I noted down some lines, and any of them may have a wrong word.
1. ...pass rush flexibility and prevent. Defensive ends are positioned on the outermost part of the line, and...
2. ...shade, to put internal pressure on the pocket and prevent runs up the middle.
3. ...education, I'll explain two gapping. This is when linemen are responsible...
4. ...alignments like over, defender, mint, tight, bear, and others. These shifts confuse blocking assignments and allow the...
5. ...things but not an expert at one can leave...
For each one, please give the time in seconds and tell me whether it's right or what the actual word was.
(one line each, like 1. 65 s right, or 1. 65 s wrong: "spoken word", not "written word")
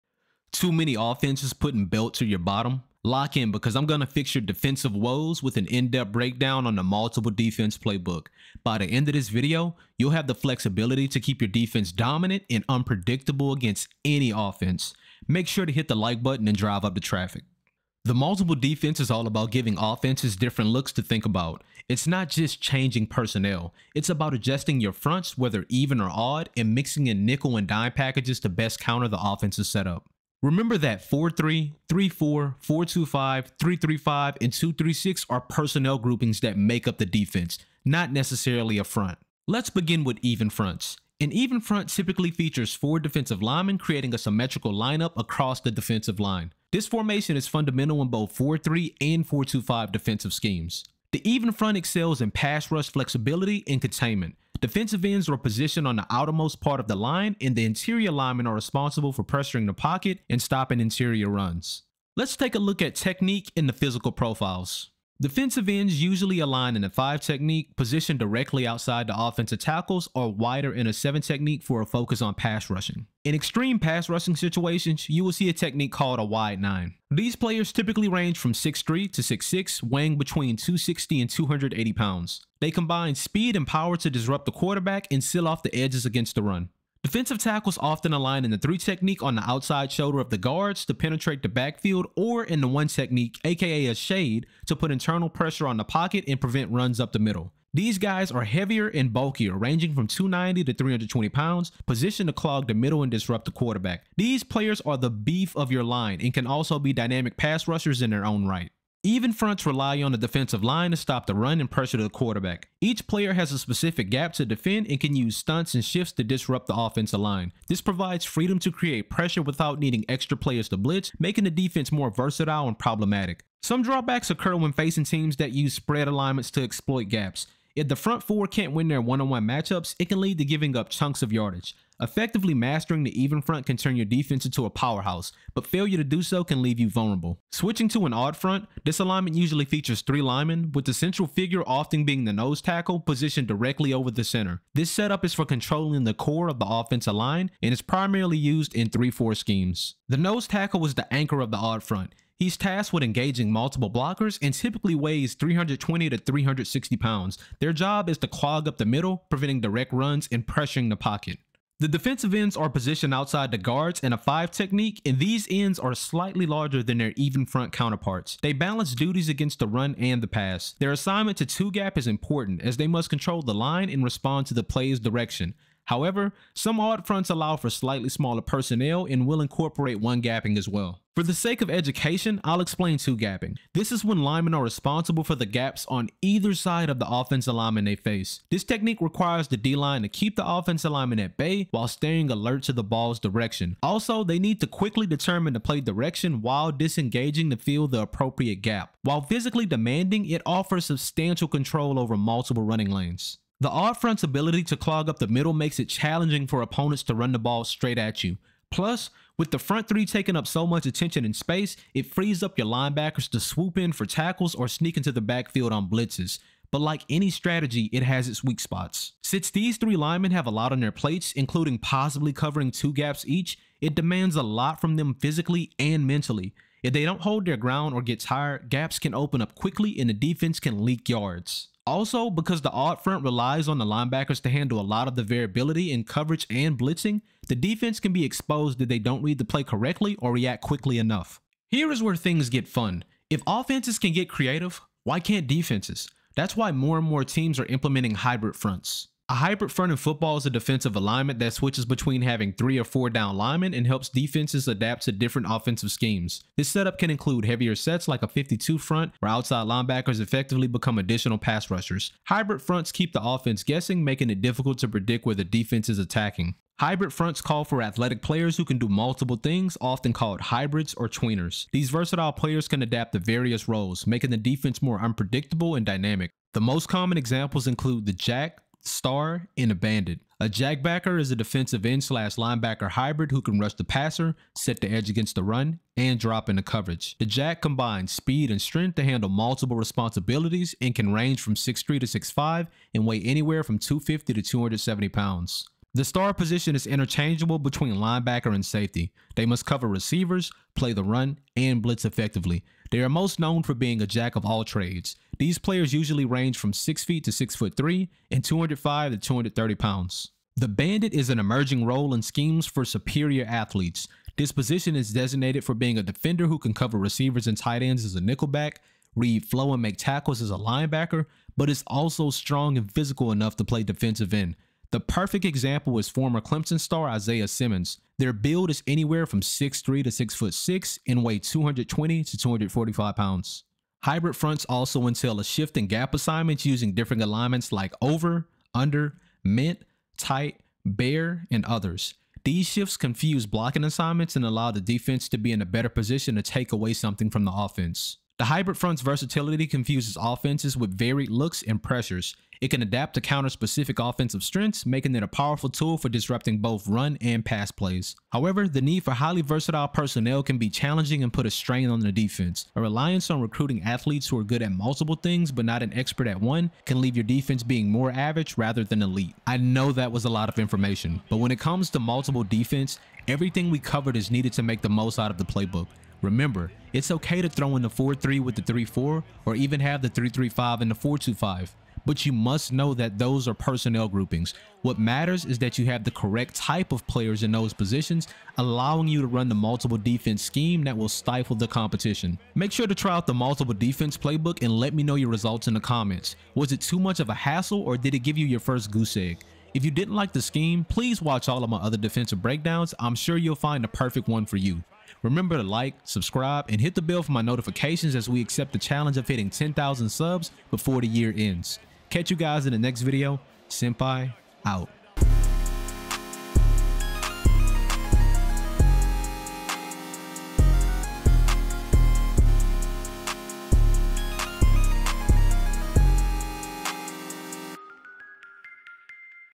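1. 52 s wrong: "containment", not "prevent"
2. 93 s right
3. 181 s right
4. 337 s wrong: "under", not "defender"
5. 365 s right.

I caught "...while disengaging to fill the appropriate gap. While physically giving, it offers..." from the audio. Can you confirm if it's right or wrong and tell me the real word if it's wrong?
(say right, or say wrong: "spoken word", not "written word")
wrong: "demanding", not "giving".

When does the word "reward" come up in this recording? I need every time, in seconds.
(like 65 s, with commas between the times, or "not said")
not said.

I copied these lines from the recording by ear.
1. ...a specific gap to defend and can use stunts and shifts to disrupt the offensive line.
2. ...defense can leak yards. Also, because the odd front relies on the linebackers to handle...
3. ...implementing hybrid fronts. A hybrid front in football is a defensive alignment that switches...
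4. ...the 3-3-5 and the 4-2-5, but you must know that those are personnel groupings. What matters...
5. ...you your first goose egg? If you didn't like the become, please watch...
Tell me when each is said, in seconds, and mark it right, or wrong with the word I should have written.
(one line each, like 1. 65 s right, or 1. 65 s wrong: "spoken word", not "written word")
1. 113 s right
2. 230 s right
3. 247 s right
4. 380 s right
5. 398 s wrong: "scheme", not "become".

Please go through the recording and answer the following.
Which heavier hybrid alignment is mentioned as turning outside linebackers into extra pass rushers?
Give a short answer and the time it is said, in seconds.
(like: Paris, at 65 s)
52 front, at 258 s.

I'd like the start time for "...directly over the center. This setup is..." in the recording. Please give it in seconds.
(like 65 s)
143 s.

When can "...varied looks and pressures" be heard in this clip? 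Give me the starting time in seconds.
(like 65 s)
350 s.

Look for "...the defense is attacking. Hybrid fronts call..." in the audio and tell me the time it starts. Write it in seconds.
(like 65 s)
265 s.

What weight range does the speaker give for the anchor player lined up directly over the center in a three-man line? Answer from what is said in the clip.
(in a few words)
320 to 360 pounds.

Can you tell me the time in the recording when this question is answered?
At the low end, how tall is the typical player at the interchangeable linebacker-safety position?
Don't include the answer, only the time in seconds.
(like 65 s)
306 s.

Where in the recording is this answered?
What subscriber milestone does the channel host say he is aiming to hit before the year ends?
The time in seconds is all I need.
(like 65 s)
409 s.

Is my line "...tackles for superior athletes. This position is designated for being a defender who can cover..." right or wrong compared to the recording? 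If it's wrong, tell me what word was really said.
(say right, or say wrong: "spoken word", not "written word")
wrong: "schemes", not "tackles".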